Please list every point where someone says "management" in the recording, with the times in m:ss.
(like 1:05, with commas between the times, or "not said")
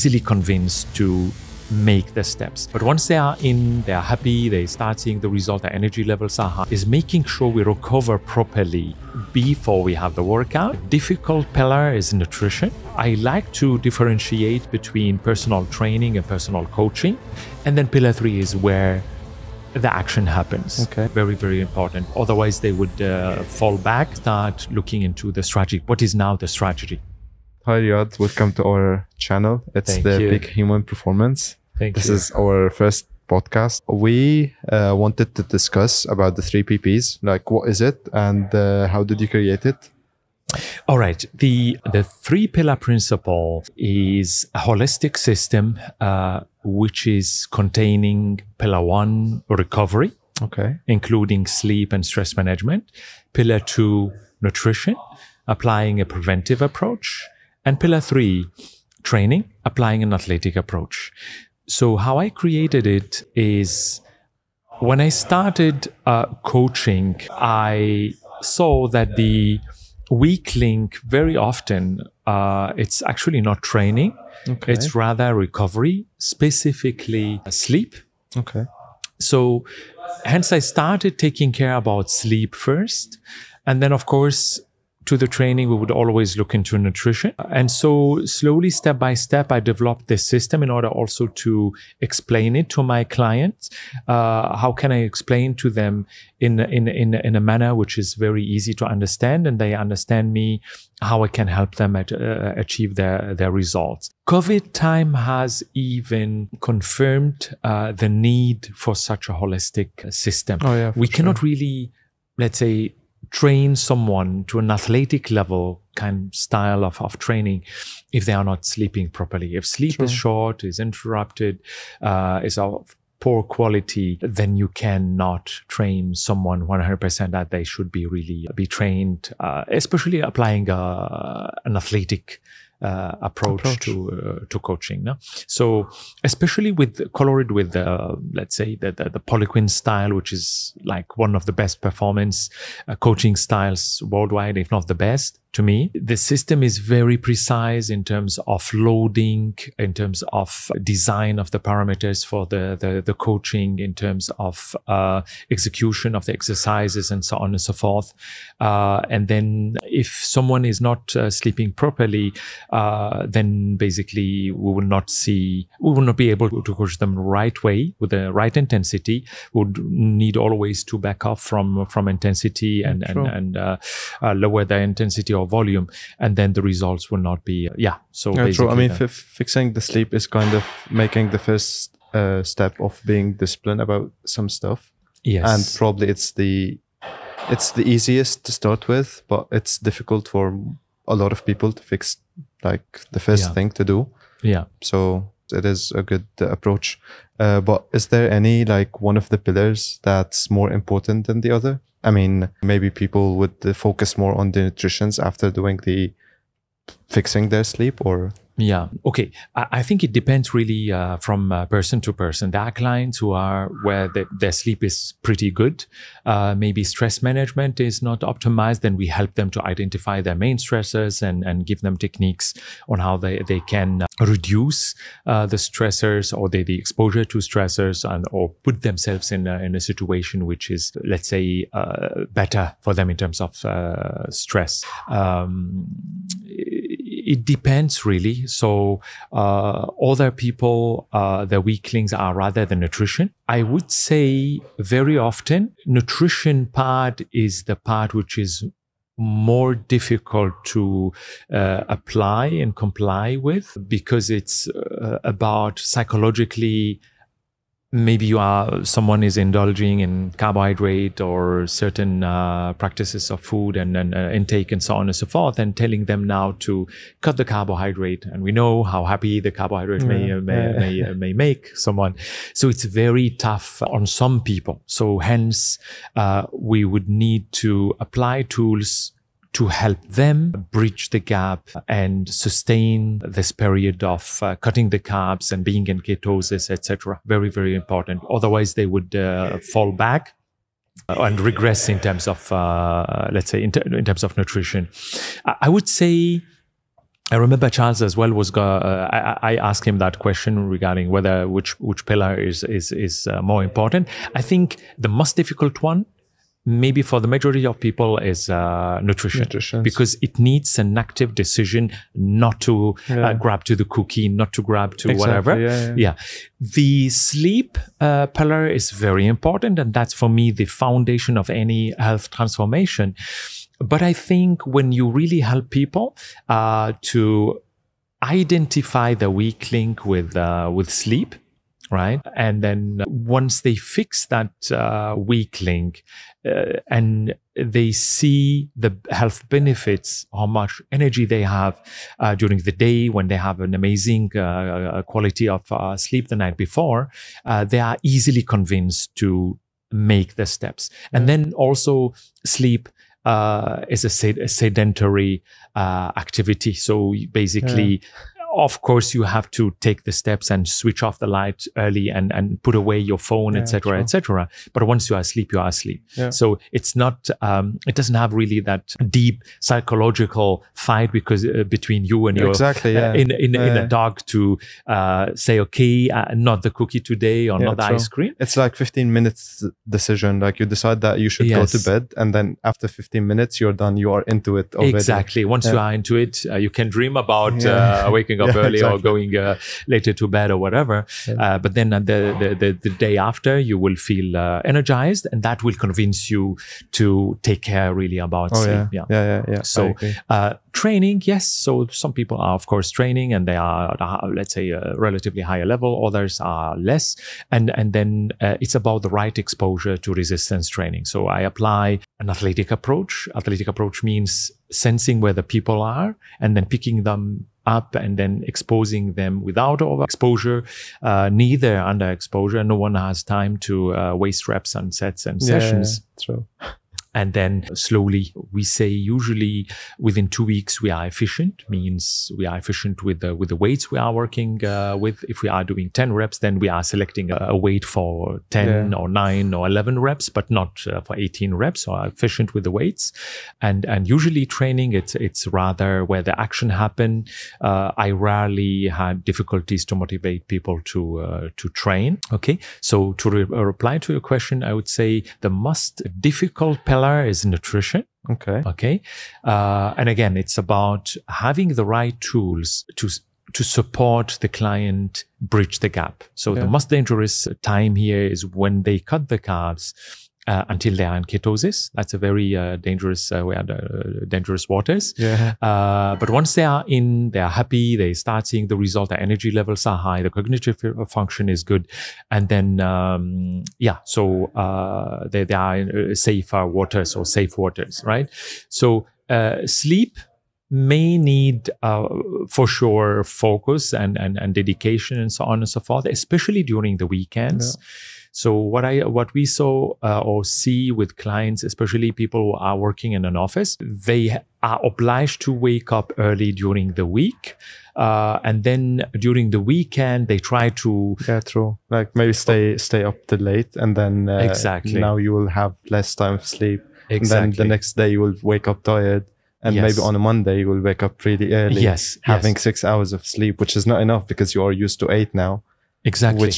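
0:52, 3:37.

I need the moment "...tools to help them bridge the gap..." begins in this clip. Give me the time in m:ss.
4:38.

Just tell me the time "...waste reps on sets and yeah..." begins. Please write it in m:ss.
7:04.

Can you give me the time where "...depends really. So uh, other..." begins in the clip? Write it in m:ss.
3:57.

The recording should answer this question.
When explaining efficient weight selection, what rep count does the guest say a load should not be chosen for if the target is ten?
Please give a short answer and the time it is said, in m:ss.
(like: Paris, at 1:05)
18 reps, at 7:21.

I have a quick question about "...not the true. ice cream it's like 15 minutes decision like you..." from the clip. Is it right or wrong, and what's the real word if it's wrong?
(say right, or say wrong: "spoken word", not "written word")
right.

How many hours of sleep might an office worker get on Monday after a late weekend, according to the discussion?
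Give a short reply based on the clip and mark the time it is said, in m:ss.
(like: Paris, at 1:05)
6 hours, at 8:42.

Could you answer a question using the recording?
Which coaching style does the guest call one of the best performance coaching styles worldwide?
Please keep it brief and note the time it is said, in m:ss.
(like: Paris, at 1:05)
Poliquin style, at 2:19.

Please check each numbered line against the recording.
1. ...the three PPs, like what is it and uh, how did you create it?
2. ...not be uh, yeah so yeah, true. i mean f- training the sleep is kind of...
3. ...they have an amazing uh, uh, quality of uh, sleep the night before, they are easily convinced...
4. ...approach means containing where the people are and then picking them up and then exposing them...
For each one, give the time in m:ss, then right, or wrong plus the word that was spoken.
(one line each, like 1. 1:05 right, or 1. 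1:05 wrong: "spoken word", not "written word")
1. 0:36 right
2. 2:57 wrong: "fixing", not "training"
3. 5:43 right
4. 6:53 wrong: "sensing", not "containing".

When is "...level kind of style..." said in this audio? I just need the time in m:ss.
1:55.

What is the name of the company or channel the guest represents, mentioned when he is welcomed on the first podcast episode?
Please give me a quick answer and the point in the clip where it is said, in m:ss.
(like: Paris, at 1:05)
Big Human Performance, at 0:30.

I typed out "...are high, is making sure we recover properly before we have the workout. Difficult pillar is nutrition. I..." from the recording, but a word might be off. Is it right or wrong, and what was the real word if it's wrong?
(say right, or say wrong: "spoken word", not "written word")
right.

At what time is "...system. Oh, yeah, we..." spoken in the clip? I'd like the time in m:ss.
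1:50.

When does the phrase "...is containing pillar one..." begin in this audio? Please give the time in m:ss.
0:47.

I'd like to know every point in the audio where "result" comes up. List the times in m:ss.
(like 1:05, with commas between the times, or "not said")
0:05, 1:43, 2:56, 7:58.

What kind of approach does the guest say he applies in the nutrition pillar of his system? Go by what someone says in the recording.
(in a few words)
preventive approach.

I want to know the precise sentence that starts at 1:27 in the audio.
And so, slowly, step by step, I developed this system in order also to explain it to my clients.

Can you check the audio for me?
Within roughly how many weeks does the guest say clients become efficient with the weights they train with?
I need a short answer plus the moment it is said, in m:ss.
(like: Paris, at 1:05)
2 weeks, at 7:10.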